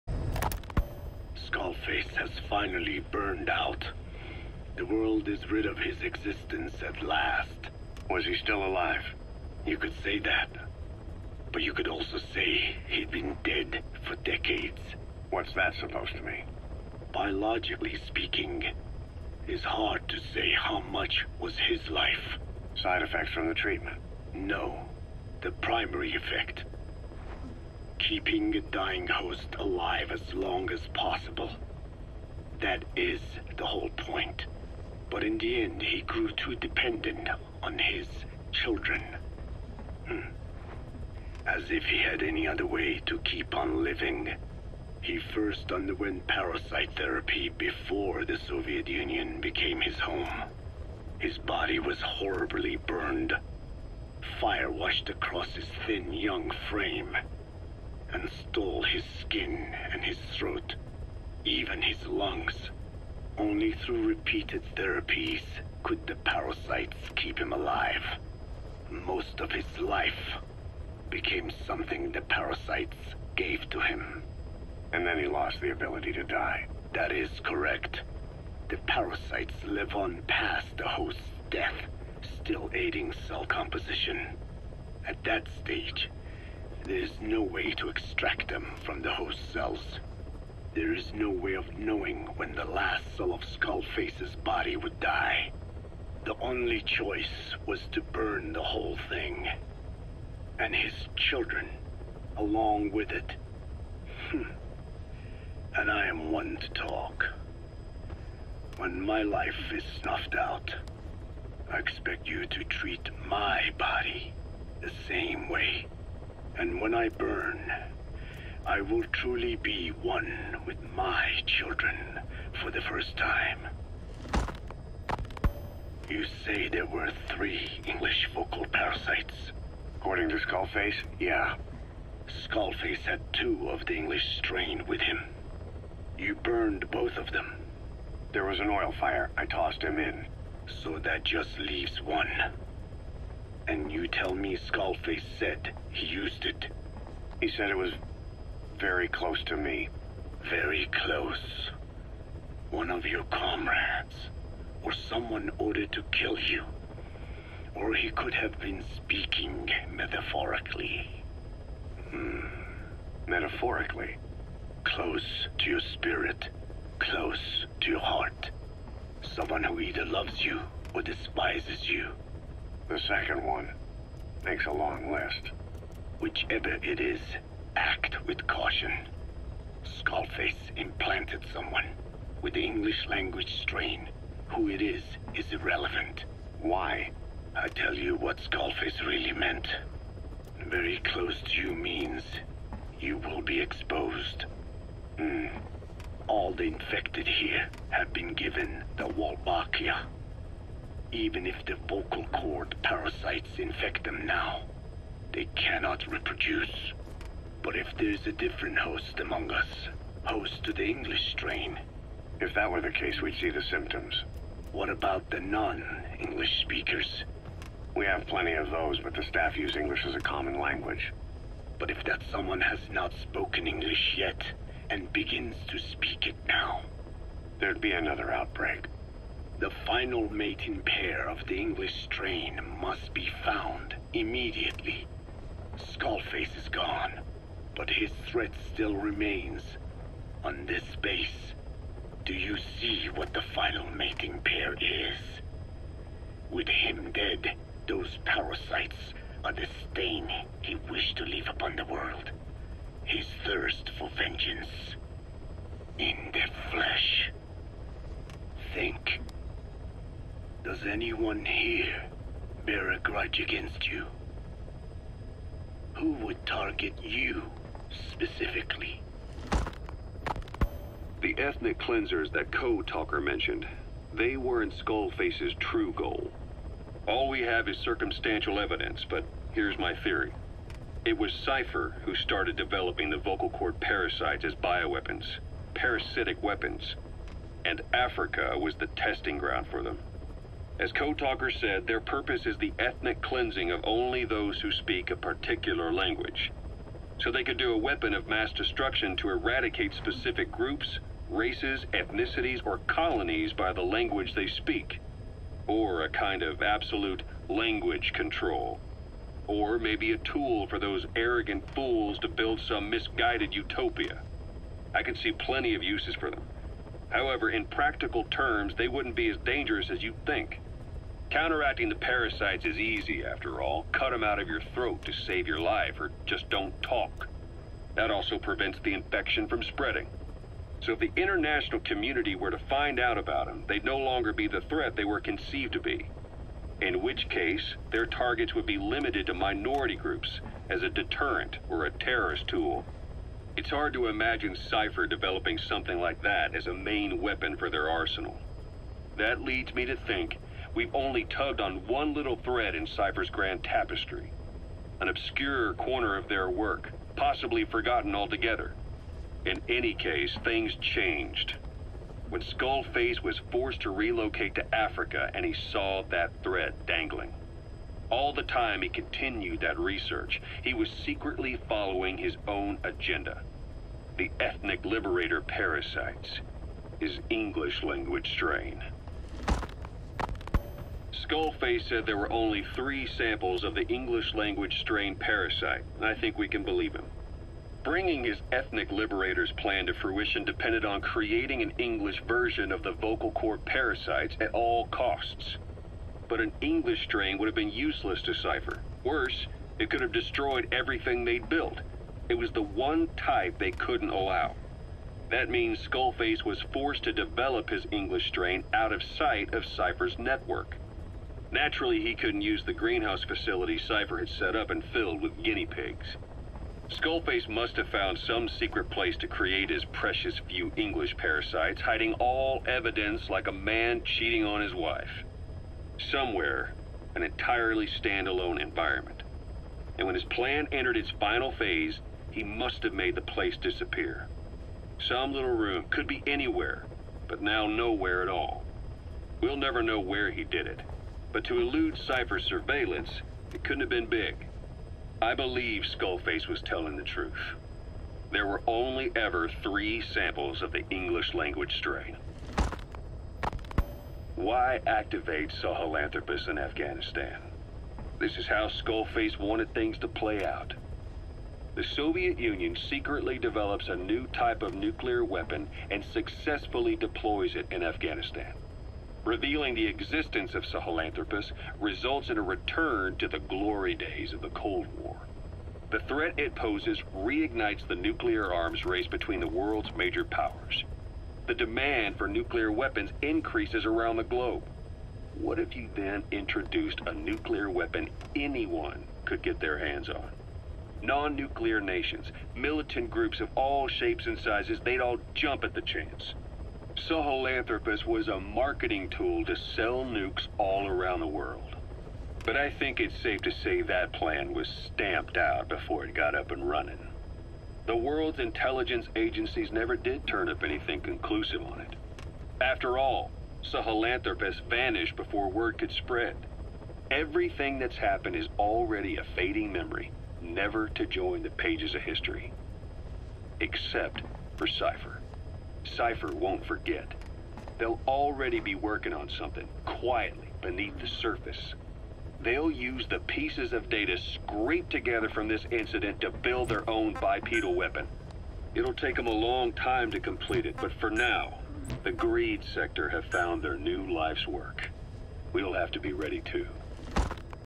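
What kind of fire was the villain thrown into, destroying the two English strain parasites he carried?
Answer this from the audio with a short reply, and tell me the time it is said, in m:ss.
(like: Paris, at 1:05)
Oil fire, at 2:18.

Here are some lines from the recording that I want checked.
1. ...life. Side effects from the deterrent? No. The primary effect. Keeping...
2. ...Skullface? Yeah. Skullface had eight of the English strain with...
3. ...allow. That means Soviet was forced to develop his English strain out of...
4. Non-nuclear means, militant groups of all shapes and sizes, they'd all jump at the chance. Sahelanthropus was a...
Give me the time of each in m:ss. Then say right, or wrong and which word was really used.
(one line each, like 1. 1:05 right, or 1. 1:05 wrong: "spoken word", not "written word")
1. 0:21 wrong: "treatment", not "deterrent"
2. 2:10 wrong: "two", not "eight"
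3. 6:44 wrong: "Skullface", not "Soviet"
4. 8:11 wrong: "nations", not "means".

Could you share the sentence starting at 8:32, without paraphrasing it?
After all, Sahelanthropus vanished before word could spread.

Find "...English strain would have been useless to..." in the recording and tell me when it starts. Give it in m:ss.
6:36.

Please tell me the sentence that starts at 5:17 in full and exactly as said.
However, in practical terms, they wouldn't be as dangerous as you would think.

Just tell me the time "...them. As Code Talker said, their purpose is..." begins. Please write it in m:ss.
4:49.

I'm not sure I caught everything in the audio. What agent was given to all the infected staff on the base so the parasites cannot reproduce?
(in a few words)
Wolbachia.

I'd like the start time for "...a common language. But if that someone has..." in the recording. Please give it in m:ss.
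3:40.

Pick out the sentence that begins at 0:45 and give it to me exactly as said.
He first underwent parasite therapy before the Soviet Union became his home.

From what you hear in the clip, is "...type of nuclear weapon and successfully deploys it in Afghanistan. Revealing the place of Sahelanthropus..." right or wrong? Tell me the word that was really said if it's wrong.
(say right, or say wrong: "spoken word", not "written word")
wrong: "existence", not "place".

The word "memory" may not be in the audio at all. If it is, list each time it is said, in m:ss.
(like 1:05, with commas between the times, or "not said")
8:39.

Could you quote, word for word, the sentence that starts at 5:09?
Or maybe a tool for those arrogant fools to build some misguided utopia.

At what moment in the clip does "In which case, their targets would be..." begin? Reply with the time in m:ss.
5:36.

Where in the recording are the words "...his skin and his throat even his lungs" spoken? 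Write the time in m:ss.
0:58.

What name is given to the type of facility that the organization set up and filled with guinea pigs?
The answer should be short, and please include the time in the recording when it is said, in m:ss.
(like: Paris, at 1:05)
Greenhouse, at 6:52.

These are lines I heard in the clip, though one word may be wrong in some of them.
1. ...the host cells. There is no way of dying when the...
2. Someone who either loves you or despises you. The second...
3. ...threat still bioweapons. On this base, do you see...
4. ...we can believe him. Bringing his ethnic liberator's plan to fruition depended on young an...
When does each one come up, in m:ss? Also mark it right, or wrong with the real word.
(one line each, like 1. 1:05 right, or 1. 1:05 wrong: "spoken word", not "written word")
1. 1:29 wrong: "knowing", not "dying"
2. 2:49 right
3. 3:58 wrong: "remains", not "bioweapons"
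4. 6:26 wrong: "creating", not "young".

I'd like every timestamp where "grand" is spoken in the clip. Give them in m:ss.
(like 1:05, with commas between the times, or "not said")
5:53.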